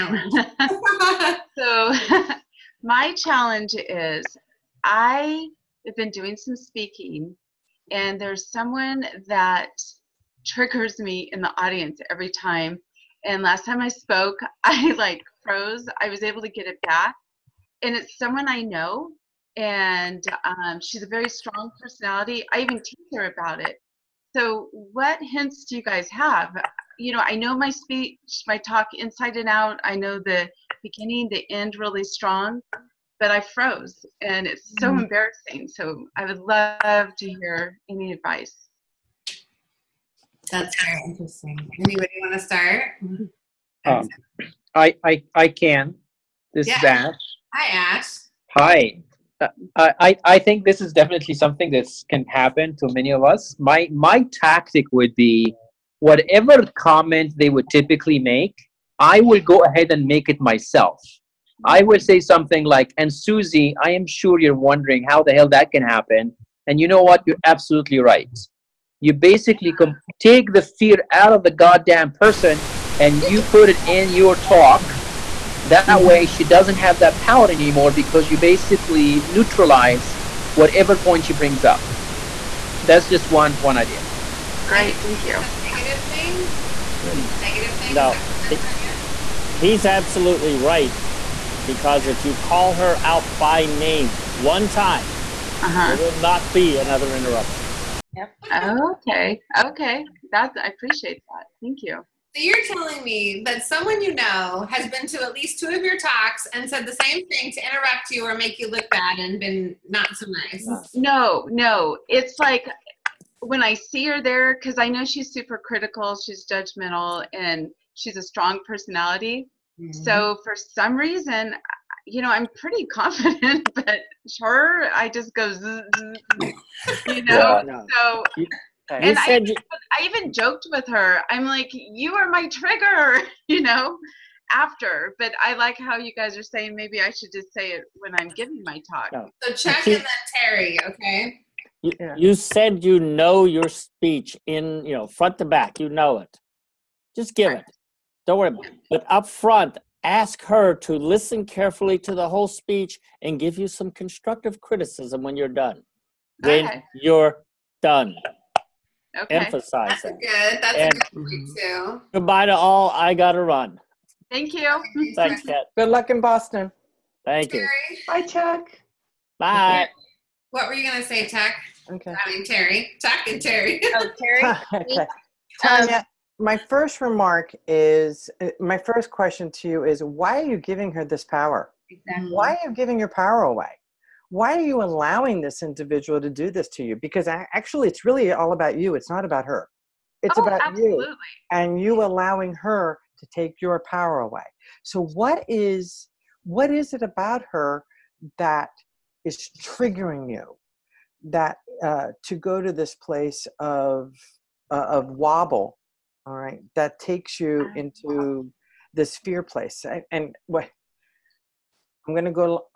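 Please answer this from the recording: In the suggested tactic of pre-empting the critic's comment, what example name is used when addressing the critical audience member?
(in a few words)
Susie.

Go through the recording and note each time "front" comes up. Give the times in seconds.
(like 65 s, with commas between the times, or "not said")
145 s, 149 s.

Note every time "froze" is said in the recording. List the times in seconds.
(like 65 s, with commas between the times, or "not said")
15 s, 33 s.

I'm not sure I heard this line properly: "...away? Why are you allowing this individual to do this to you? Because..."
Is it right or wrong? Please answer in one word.
right.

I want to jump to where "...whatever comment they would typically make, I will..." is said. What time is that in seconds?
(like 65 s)
55 s.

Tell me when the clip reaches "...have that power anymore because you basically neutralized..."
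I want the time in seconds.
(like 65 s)
76 s.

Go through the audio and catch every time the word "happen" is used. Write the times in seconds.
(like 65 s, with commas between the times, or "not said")
52 s, 65 s.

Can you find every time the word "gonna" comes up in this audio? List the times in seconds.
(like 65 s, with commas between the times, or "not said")
170 s, 212 s.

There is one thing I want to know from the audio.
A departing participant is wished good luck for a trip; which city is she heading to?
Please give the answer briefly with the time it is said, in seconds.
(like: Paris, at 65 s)
Boston, at 166 s.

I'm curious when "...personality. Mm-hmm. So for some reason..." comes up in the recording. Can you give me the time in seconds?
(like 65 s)
118 s.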